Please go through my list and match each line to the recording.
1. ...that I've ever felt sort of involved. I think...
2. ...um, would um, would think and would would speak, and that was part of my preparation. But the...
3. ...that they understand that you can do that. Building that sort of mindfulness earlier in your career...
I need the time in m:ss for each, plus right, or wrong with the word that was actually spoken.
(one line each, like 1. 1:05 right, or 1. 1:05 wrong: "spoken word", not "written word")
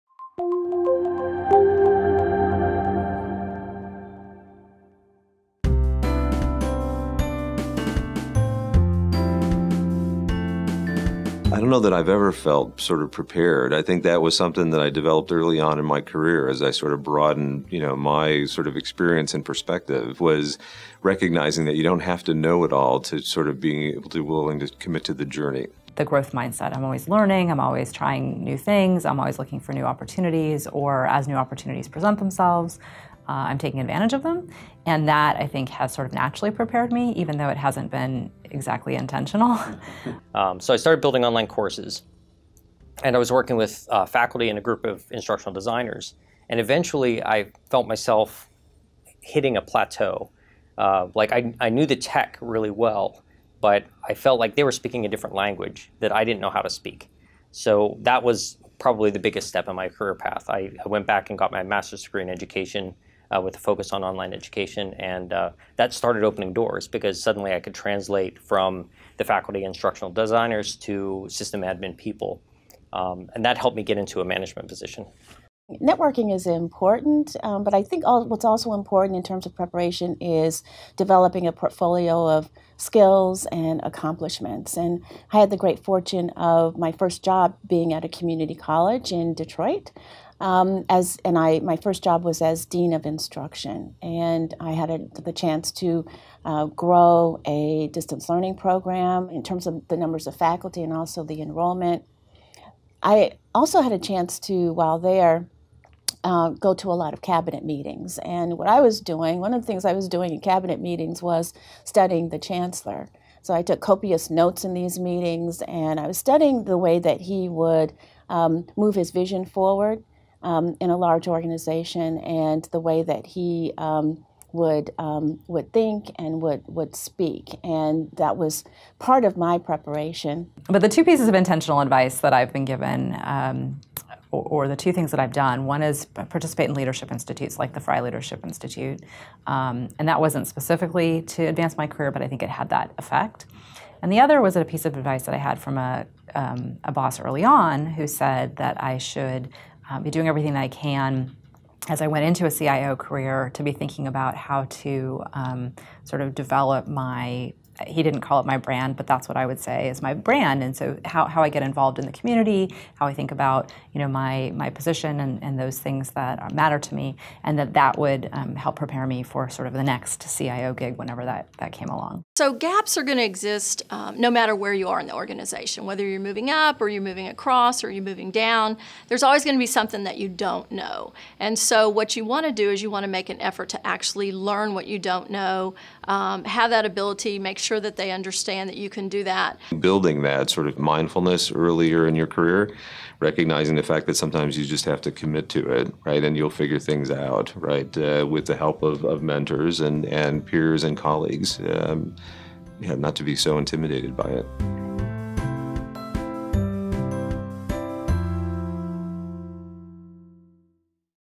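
1. 0:11 wrong: "prepared", not "involved"
2. 2:03 right
3. 3:07 right.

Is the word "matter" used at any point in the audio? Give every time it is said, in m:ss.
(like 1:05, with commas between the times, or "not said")
2:46, 2:54.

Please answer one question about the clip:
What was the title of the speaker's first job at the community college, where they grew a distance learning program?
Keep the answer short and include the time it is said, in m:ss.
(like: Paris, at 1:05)
dean of instruction, at 1:32.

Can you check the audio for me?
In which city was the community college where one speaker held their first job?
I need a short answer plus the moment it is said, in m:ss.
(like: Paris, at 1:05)
Detroit, at 1:29.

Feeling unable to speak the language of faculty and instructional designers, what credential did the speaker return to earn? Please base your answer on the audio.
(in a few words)
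master's degree in education.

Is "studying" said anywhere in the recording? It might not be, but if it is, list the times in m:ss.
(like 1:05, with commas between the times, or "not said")
1:51, 1:56.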